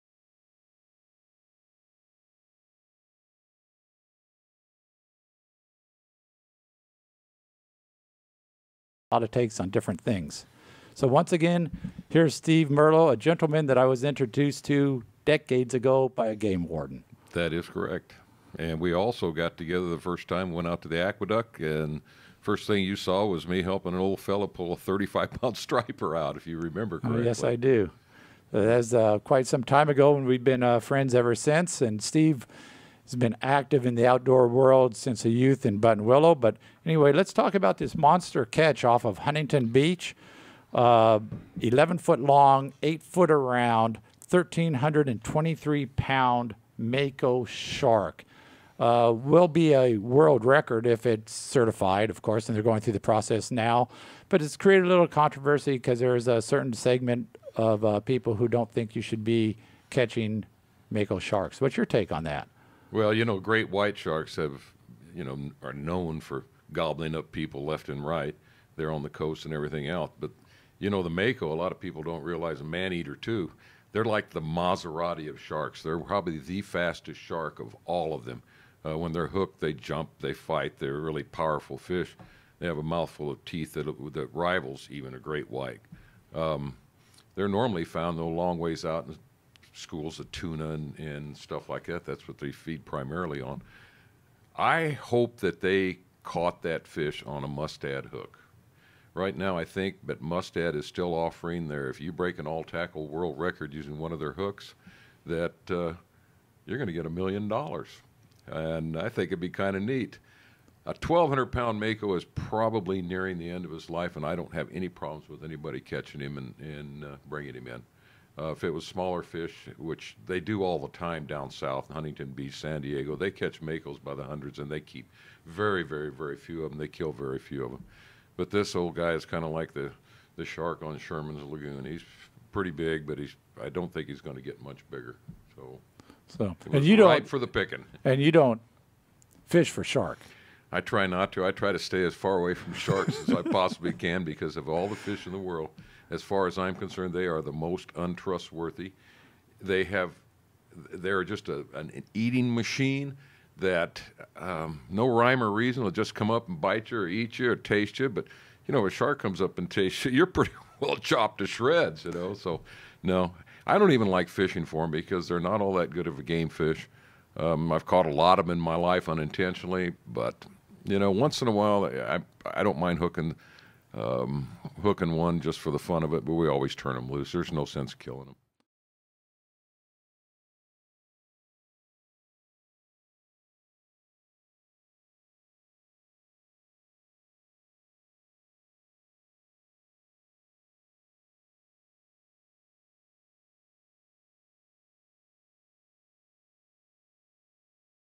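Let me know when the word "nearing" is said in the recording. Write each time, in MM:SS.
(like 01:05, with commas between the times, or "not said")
01:53.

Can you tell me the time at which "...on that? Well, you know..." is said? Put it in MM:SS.
01:02.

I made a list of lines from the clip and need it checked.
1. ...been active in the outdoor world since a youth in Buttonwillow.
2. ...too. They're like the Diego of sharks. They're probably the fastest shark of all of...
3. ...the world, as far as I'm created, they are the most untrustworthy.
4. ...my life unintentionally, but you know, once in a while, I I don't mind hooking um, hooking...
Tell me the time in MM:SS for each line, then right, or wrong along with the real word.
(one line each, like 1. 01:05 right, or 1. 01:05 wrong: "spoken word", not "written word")
1. 00:33 right
2. 01:13 wrong: "Maserati", not "Diego"
3. 02:25 wrong: "concerned", not "created"
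4. 02:48 right.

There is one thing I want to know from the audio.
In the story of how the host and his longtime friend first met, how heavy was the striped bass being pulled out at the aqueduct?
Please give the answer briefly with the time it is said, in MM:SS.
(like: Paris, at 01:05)
35 pounds, at 00:24.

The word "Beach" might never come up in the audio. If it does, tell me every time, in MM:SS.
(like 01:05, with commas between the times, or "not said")
00:39, 02:02.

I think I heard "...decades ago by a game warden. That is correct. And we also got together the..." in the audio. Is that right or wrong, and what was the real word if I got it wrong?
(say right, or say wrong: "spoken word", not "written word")
right.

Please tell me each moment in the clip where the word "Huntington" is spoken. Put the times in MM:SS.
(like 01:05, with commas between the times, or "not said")
00:39, 02:01.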